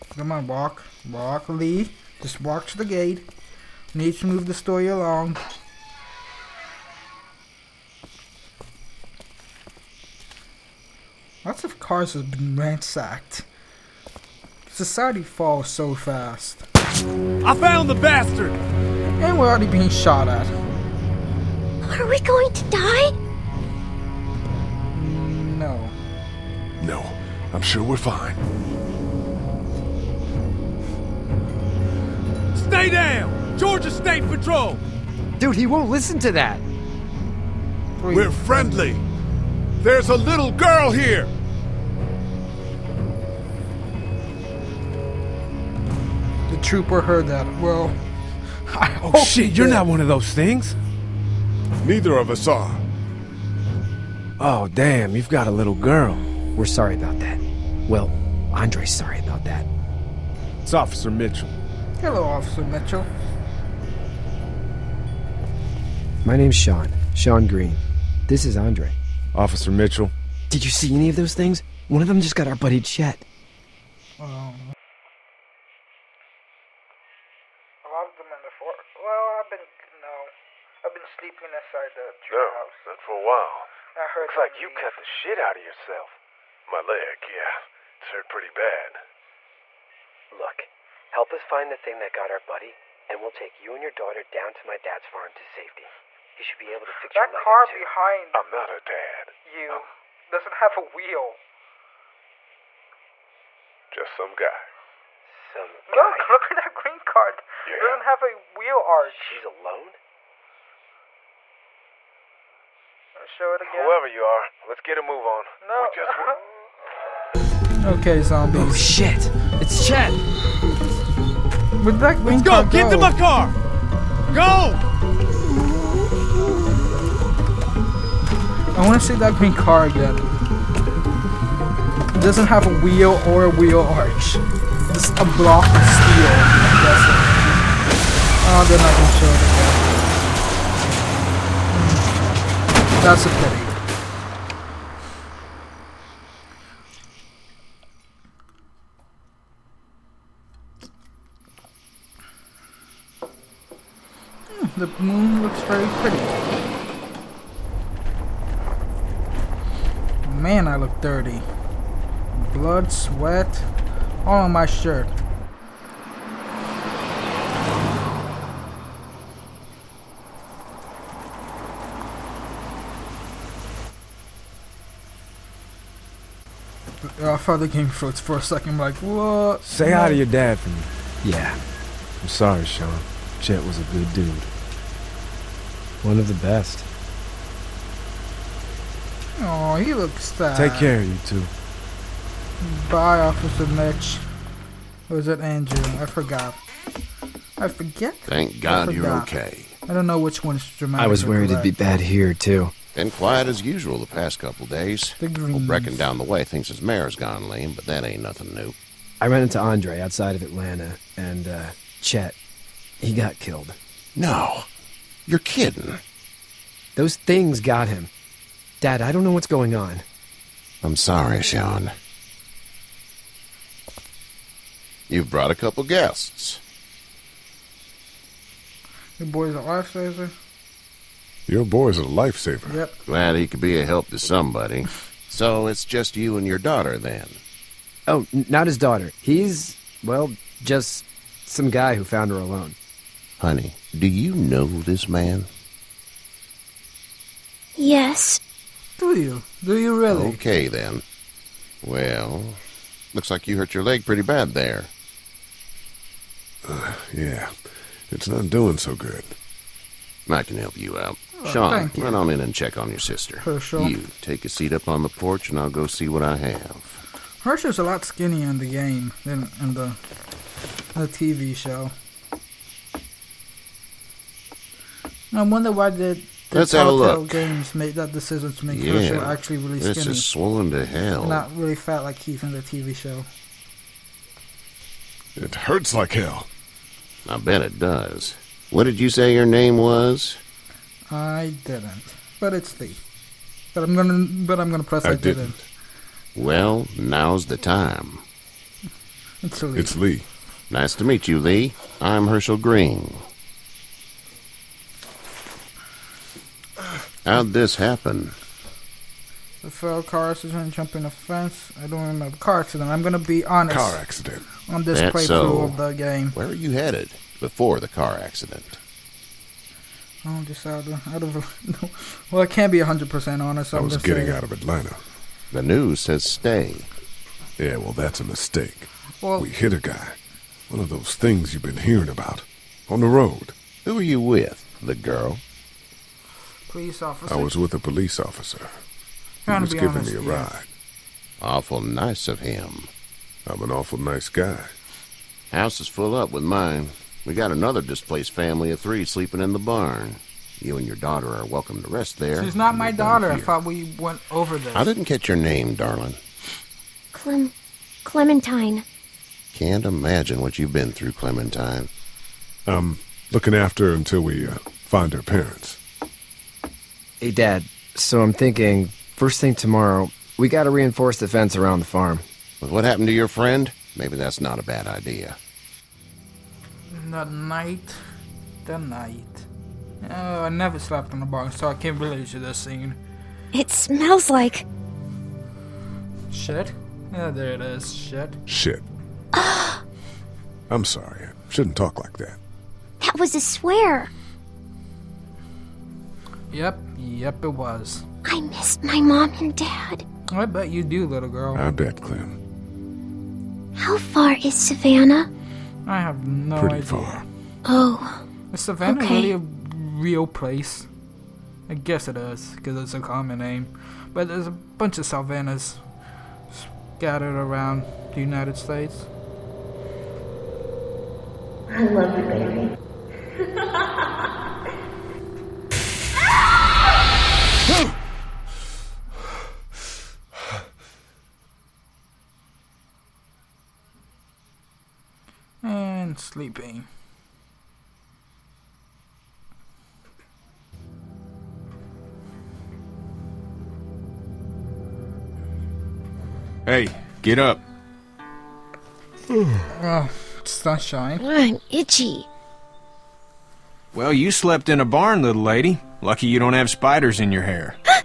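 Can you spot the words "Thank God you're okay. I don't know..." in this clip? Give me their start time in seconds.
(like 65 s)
198 s.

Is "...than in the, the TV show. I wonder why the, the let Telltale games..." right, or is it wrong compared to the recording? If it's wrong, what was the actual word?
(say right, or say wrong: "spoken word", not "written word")
right.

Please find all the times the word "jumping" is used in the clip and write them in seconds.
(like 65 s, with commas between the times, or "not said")
310 s.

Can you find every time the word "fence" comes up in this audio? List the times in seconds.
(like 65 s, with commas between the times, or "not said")
311 s, 371 s.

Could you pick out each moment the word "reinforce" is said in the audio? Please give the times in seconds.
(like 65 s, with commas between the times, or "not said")
370 s.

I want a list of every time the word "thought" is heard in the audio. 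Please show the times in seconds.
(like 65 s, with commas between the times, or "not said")
177 s, 353 s.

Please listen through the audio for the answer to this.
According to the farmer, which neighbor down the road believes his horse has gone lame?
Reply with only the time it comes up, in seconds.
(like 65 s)
205 s.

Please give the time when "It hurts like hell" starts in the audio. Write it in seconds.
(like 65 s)
285 s.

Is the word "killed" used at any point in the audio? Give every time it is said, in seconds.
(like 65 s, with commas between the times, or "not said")
213 s.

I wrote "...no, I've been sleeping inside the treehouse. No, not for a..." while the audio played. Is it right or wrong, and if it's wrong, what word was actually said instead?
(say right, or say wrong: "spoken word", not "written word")
right.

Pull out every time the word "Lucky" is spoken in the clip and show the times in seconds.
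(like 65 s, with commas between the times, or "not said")
456 s.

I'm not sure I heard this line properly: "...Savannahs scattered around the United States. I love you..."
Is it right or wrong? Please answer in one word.
right.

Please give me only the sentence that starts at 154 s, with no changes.
Hmm, the moon looks very pretty.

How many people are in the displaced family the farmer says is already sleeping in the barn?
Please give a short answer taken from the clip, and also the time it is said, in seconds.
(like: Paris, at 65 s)
3, at 348 s.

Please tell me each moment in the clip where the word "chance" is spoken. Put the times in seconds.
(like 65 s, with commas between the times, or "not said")
not said.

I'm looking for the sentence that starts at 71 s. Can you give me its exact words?
One of them just got our buddy Chet.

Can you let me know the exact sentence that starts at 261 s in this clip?
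Oh, Shawn, run on in and check on your sister.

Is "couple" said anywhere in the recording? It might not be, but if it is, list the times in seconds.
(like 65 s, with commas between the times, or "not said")
204 s, 225 s.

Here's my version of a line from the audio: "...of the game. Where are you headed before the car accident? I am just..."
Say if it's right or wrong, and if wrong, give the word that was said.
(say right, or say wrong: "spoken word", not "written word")
right.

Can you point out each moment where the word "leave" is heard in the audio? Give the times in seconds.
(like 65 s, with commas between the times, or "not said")
84 s.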